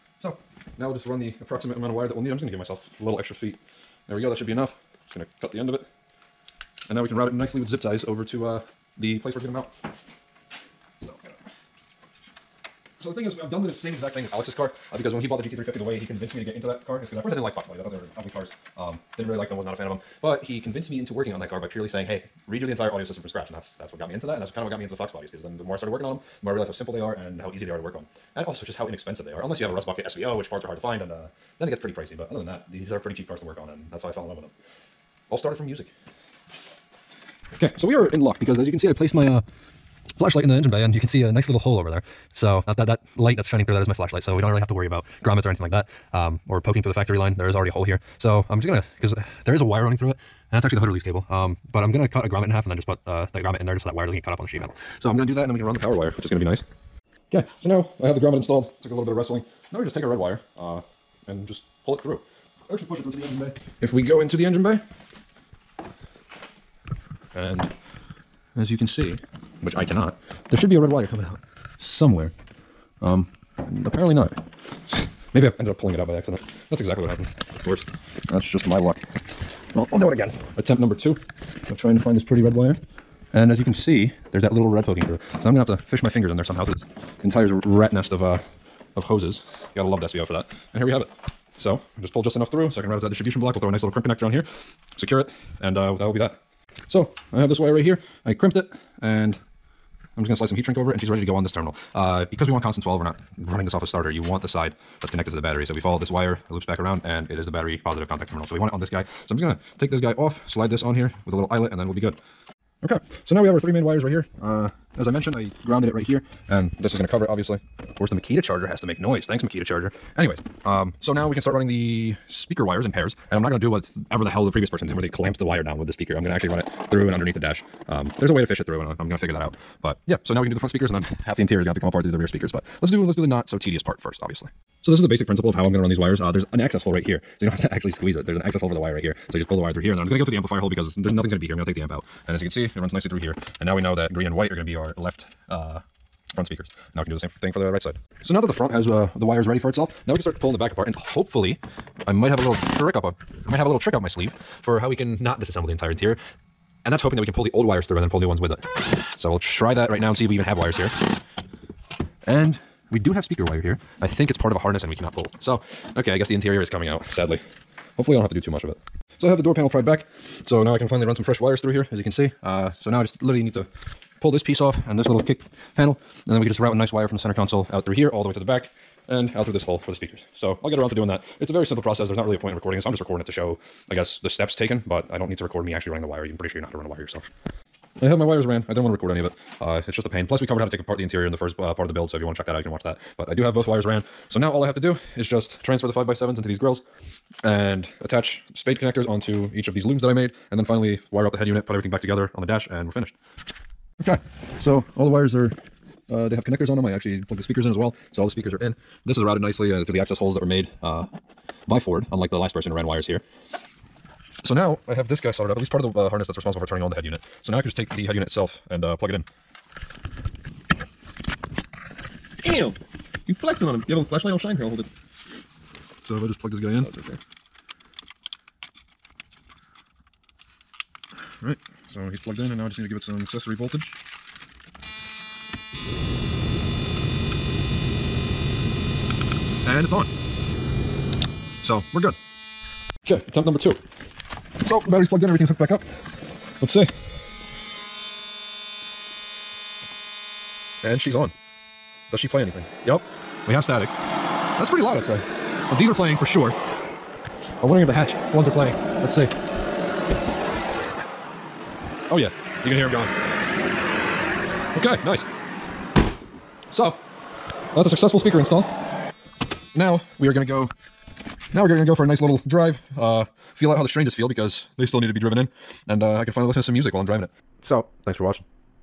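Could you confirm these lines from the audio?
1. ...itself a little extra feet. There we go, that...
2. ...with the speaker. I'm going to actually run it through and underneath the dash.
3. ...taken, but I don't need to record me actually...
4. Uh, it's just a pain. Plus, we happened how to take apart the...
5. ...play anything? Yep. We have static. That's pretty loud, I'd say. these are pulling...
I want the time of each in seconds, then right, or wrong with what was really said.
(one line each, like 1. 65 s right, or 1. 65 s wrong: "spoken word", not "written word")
1. 2 s wrong: "myself", not "itself"
2. 125 s right
3. 184 s right
4. 189 s wrong: "covered", not "happened"
5. 252 s wrong: "playing", not "pulling".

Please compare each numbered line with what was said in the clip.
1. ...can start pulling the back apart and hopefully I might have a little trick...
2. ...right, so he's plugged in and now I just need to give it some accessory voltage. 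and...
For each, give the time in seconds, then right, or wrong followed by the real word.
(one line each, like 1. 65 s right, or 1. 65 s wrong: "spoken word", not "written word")
1. 150 s right
2. 231 s right.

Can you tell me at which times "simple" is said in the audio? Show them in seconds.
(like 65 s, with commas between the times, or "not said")
26 s, 181 s.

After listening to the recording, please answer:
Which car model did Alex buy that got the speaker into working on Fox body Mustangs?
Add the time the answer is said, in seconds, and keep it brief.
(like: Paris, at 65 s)
GT350, at 15 s.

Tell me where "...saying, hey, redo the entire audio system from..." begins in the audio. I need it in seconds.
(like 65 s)
21 s.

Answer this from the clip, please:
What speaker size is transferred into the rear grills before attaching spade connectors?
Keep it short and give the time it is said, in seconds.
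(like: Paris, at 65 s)
5x7, at 195 s.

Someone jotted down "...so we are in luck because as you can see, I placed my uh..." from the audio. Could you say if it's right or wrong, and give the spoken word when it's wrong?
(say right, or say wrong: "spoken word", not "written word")
right.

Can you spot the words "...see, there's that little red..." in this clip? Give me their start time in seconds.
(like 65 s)
83 s.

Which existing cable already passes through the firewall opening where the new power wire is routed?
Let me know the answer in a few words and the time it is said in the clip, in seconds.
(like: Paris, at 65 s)
Hood release cable, at 50 s.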